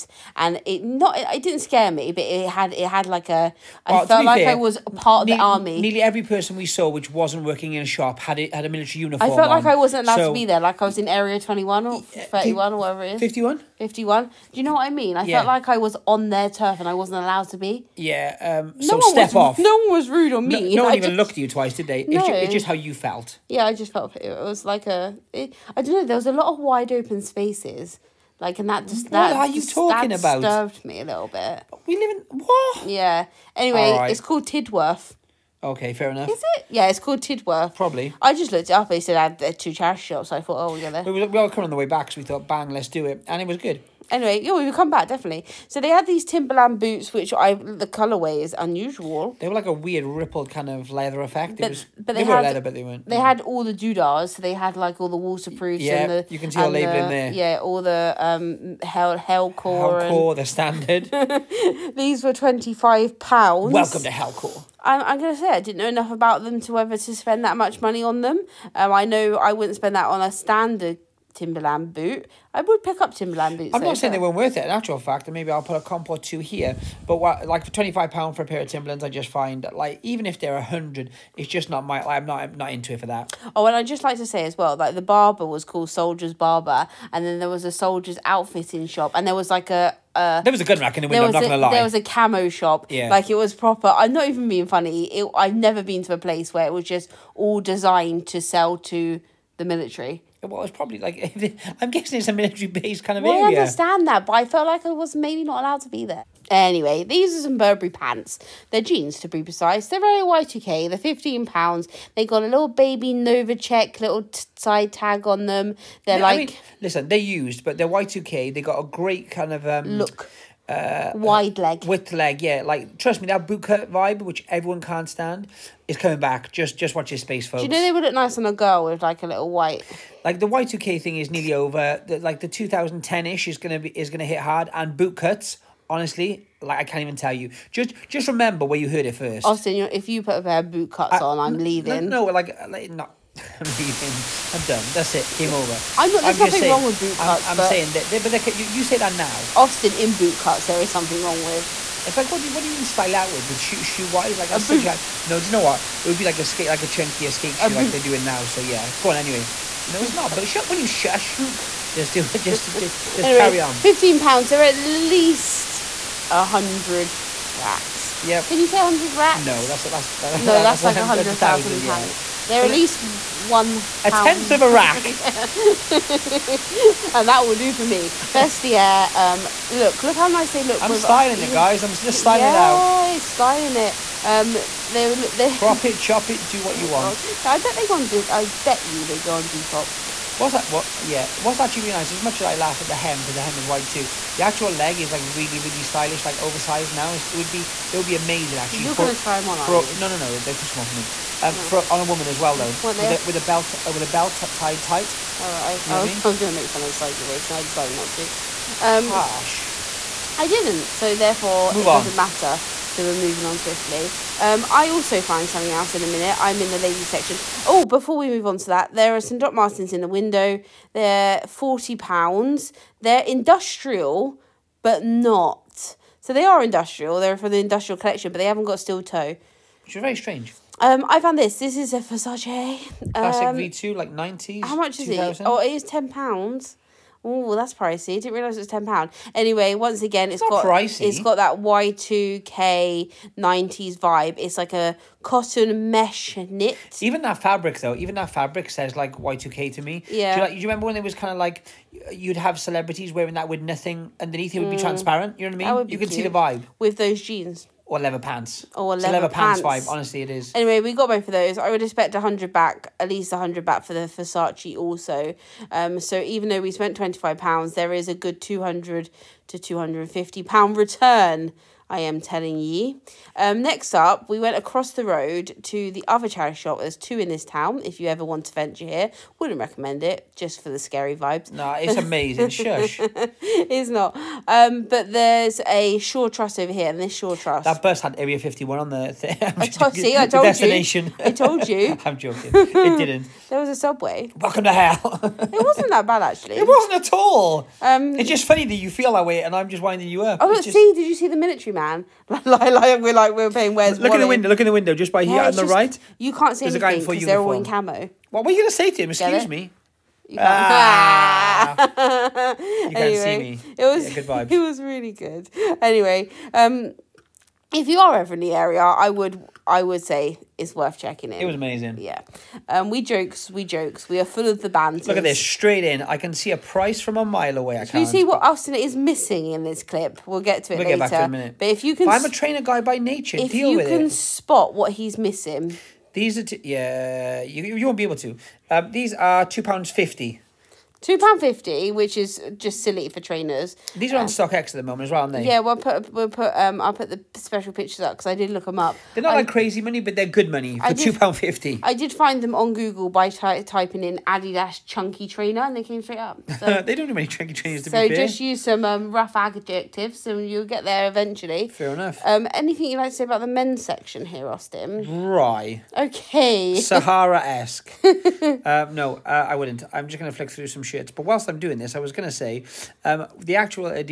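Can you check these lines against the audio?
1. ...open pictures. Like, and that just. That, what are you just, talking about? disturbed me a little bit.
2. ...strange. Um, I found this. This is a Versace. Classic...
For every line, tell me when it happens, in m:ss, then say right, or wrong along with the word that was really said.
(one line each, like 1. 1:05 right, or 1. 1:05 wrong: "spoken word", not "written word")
1. 0:26 wrong: "spaces", not "pictures"
2. 3:50 right.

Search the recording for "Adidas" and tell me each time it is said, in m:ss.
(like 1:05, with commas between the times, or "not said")
5:54.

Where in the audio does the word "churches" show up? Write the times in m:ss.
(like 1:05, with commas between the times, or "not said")
not said.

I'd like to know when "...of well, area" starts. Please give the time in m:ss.
1:43.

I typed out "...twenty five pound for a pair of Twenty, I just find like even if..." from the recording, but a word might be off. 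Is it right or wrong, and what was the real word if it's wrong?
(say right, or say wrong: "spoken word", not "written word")
wrong: "Timberlands", not "Twenty".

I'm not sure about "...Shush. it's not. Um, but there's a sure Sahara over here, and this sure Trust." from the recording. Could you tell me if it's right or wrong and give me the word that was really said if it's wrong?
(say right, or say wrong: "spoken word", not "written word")
wrong: "Trust", not "Sahara".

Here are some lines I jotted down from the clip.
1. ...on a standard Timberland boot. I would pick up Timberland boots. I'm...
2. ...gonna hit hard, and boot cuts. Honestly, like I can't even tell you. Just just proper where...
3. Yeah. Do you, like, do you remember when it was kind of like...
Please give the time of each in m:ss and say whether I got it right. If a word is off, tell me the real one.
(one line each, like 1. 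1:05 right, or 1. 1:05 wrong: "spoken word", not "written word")
1. 1:10 right
2. 2:14 wrong: "remember", not "proper"
3. 4:10 right.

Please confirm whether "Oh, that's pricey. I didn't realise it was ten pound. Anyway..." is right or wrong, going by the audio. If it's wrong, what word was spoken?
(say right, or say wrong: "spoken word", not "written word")
right.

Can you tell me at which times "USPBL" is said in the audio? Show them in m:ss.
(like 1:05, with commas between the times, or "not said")
not said.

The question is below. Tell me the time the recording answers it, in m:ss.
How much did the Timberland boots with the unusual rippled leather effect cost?
1:01.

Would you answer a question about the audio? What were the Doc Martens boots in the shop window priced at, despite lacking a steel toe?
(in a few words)
£40.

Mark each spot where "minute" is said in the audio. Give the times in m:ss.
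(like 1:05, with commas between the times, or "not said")
3:36, 5:31.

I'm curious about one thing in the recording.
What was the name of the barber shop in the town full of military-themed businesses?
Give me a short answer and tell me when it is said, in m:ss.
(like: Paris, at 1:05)
Soldier's Barber, at 1:25.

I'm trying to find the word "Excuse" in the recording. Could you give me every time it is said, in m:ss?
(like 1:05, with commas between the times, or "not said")
5:09.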